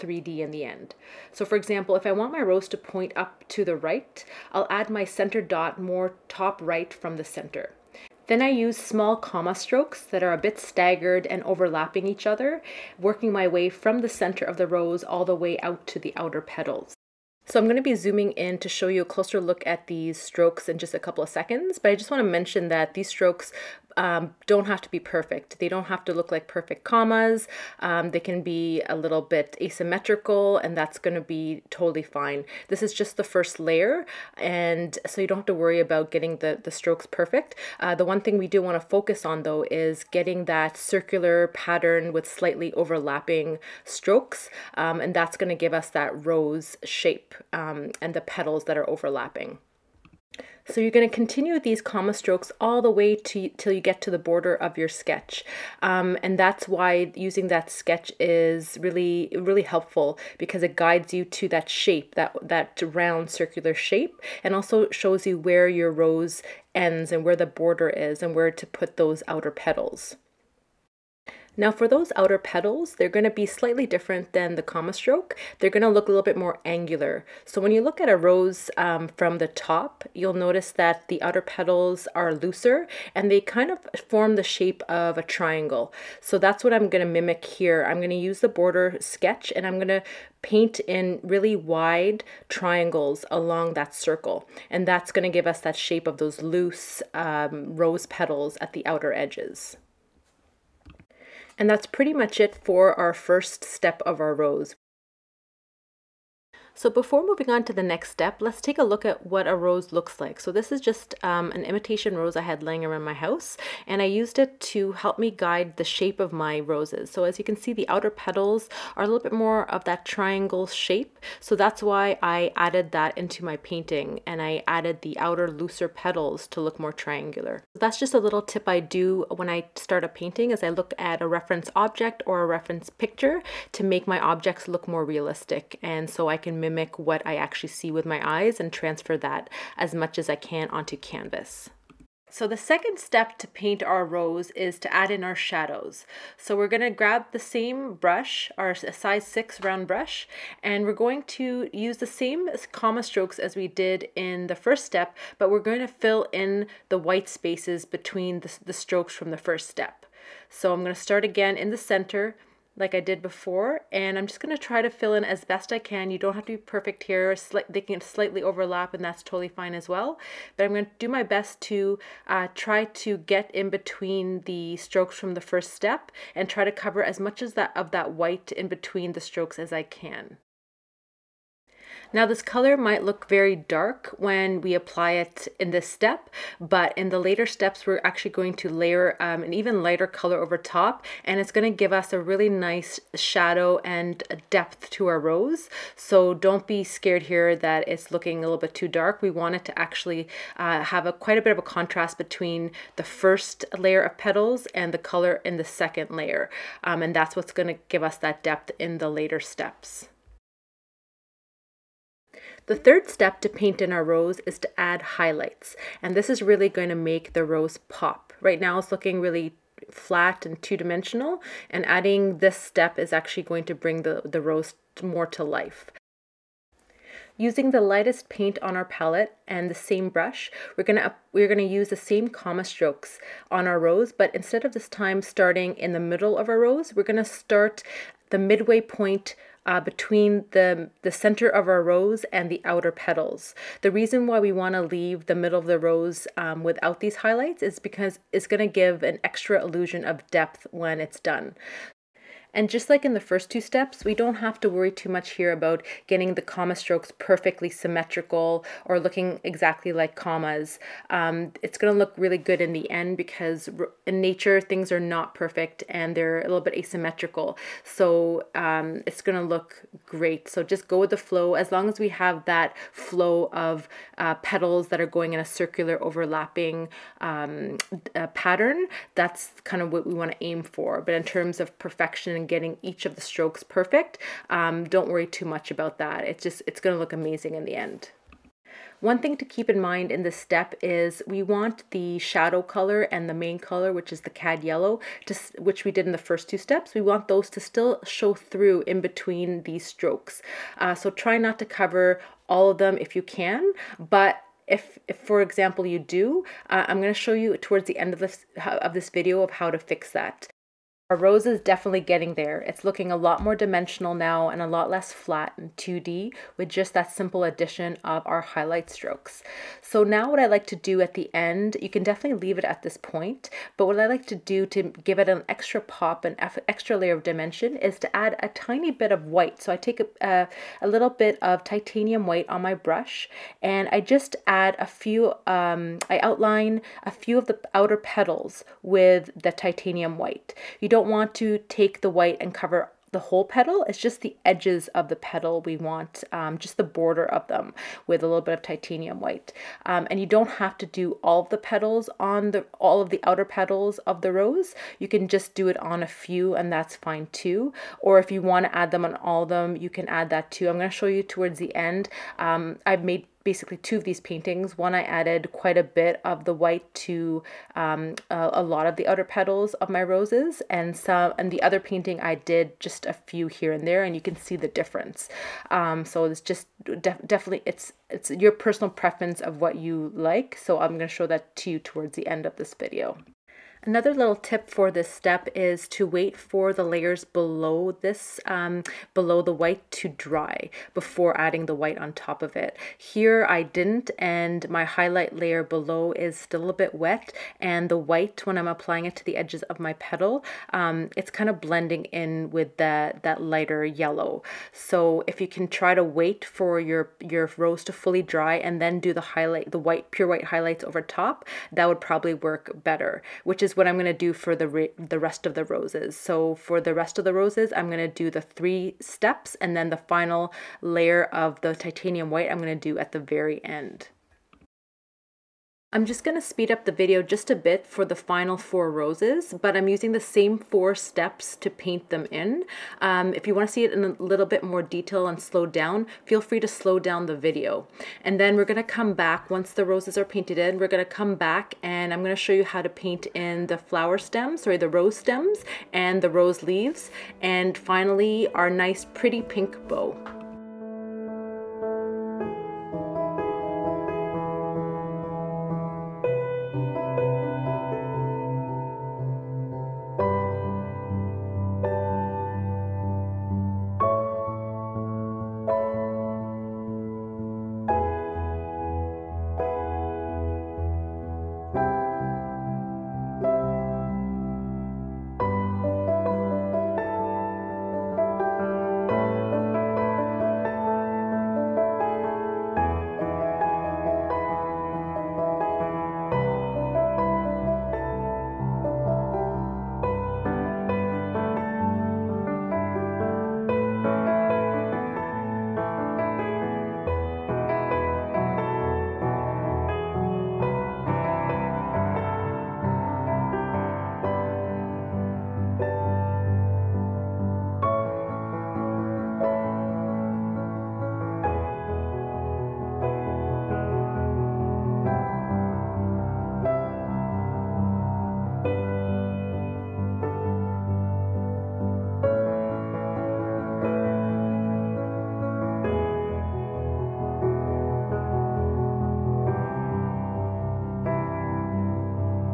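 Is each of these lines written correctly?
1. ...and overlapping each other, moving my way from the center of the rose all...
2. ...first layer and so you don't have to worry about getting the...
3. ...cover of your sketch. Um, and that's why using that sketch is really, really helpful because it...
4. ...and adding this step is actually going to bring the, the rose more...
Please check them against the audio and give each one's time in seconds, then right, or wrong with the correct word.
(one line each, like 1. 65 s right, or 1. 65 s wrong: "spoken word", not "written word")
1. 11 s wrong: "working", not "moving"
2. 33 s right
3. 54 s wrong: "border", not "cover"
4. 221 s right.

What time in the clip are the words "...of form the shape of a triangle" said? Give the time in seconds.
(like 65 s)
83 s.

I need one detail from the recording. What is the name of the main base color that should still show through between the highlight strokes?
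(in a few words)
cad yellow.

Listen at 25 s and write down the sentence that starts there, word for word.
They don't have to look like perfect commas.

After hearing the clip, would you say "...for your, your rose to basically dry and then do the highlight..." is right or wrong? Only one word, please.
wrong.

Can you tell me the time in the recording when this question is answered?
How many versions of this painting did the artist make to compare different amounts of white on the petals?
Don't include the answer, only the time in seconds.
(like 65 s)
363 s.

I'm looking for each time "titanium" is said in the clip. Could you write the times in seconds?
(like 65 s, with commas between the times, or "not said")
331 s, 339 s, 348 s, 421 s.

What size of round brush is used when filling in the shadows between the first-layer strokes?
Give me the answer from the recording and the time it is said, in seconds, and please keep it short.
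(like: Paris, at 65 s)
6, at 148 s.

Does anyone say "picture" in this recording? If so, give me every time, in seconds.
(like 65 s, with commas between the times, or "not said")
132 s.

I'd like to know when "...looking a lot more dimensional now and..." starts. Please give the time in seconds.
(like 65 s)
312 s.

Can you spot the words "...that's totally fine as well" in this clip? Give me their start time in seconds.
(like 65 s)
169 s.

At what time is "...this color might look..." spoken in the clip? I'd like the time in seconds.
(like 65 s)
182 s.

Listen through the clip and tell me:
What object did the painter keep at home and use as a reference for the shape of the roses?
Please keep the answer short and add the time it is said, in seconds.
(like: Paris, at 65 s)
imitation rose, at 111 s.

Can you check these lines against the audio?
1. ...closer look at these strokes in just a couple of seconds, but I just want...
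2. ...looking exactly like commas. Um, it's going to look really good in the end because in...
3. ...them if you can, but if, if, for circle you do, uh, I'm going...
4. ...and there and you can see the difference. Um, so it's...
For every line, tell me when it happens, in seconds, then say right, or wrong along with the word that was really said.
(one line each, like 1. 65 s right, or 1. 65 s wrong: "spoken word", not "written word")
1. 19 s right
2. 258 s right
3. 302 s wrong: "example", not "circle"
4. 373 s right.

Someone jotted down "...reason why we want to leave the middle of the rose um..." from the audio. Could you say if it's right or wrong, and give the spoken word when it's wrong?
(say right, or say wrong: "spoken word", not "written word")
right.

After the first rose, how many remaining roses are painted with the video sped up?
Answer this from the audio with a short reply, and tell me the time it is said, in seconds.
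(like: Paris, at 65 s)
4, at 428 s.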